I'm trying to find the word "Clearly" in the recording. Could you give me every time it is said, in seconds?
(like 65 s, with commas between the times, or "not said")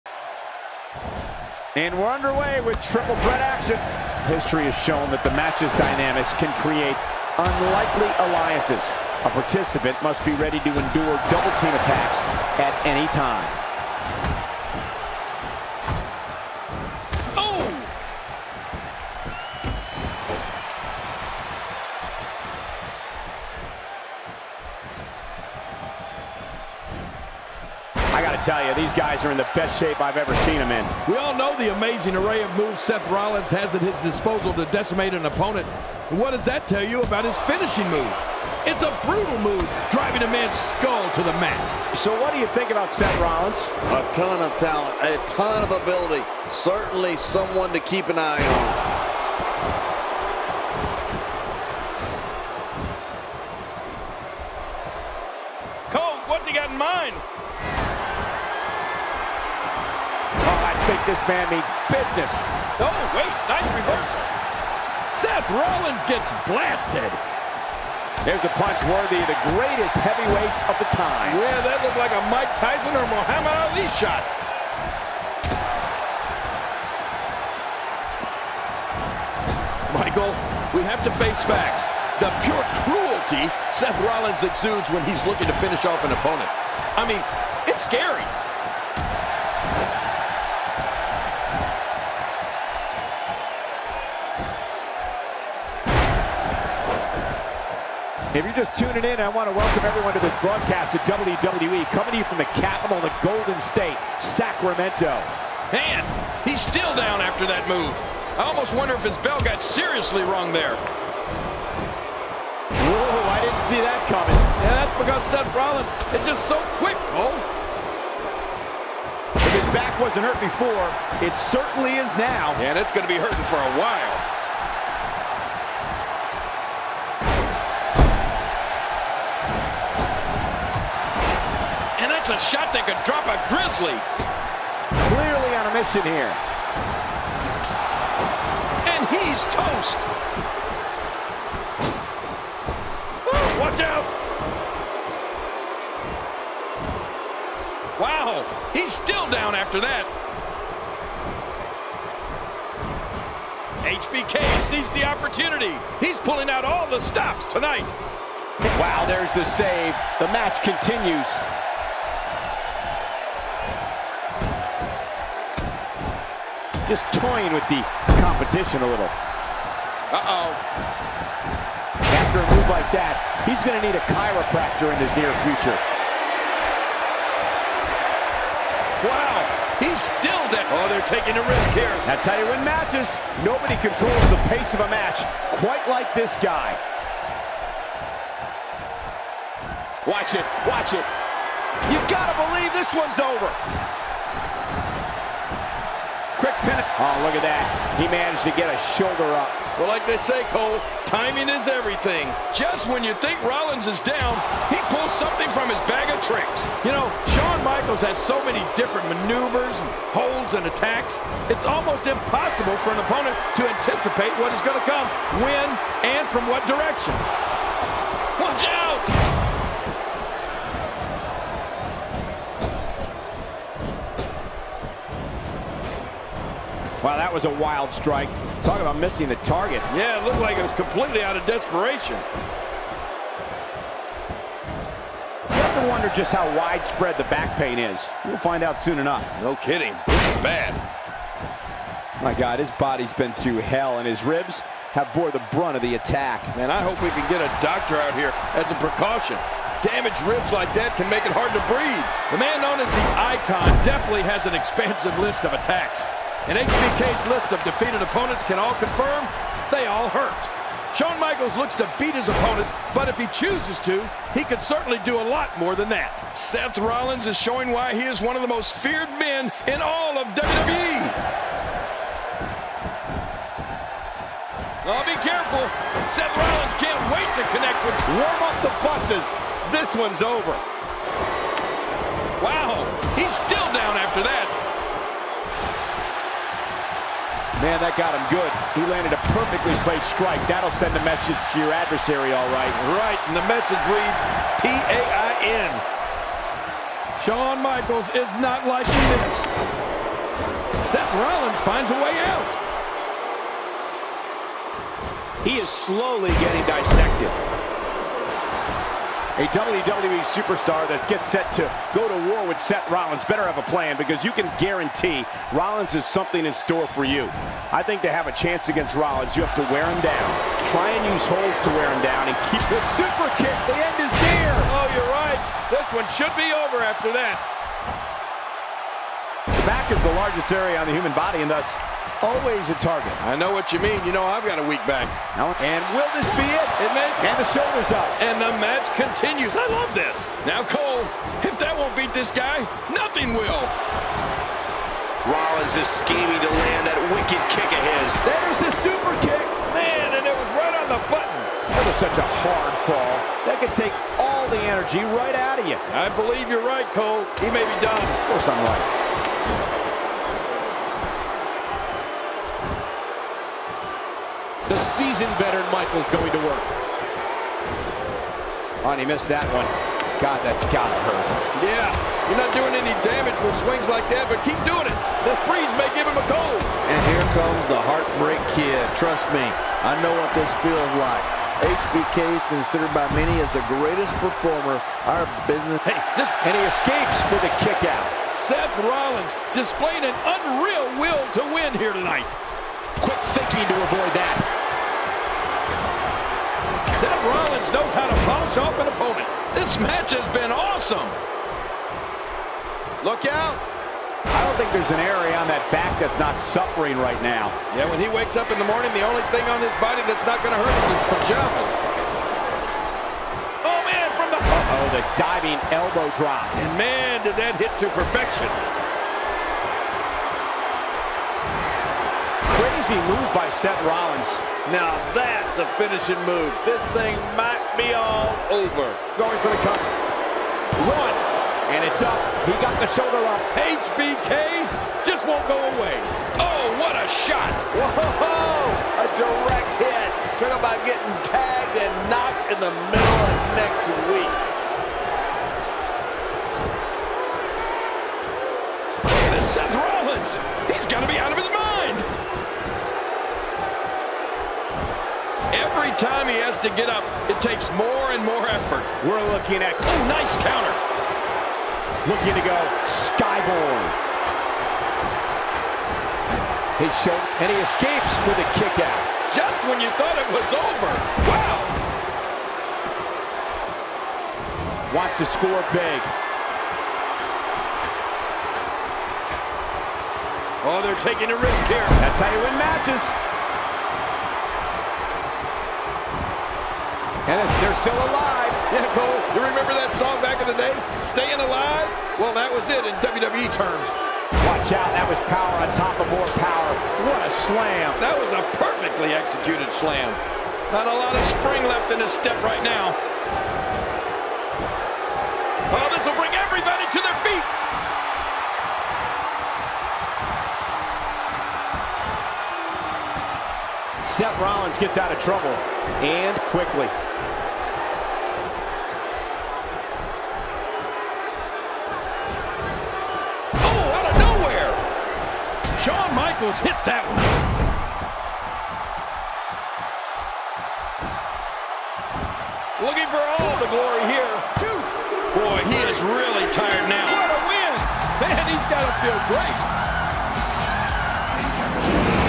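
135 s.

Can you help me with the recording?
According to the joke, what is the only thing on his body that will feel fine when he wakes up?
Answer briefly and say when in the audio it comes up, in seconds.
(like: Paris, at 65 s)
his pajamas, at 410 s.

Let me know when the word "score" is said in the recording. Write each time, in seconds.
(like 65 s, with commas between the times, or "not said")
475 s.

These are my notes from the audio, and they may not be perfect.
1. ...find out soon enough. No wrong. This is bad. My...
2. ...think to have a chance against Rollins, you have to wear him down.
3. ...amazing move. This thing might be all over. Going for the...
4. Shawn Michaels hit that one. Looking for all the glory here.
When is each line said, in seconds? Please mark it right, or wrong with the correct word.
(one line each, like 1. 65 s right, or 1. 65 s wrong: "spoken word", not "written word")
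1. 238 s wrong: "kidding", not "wrong"
2. 317 s right
3. 425 s wrong: "finishing", not "amazing"
4. 525 s right.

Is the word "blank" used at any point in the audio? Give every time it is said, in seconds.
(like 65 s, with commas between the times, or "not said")
not said.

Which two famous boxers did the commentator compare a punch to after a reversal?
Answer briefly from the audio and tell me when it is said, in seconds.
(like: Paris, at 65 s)
Mike Tyson or Muhammad Ali, at 72 s.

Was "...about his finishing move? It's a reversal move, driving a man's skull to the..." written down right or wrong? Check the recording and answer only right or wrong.
wrong.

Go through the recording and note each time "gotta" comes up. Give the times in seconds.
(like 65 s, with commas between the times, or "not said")
192 s, 370 s.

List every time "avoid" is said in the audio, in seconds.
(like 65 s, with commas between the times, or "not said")
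393 s.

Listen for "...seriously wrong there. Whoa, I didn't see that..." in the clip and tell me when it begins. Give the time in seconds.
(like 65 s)
109 s.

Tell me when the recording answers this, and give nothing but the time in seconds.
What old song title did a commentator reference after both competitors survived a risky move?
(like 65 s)
491 s.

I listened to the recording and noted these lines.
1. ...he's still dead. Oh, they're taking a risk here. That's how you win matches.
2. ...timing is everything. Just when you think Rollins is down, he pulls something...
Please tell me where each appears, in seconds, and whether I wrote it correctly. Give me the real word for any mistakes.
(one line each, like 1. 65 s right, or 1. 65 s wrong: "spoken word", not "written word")
1. 179 s right
2. 201 s right.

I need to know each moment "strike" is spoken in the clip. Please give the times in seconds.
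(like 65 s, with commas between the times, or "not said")
227 s, 290 s.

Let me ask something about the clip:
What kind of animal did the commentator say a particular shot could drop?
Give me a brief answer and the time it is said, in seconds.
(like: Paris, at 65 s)
Grizzly, at 133 s.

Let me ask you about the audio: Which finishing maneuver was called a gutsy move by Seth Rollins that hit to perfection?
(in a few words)
diving elbow drop.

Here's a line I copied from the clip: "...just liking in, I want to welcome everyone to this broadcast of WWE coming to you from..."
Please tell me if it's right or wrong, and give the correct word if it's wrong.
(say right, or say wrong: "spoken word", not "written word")
wrong: "tuning", not "liking".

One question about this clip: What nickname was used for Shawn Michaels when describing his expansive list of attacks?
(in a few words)
the Icon.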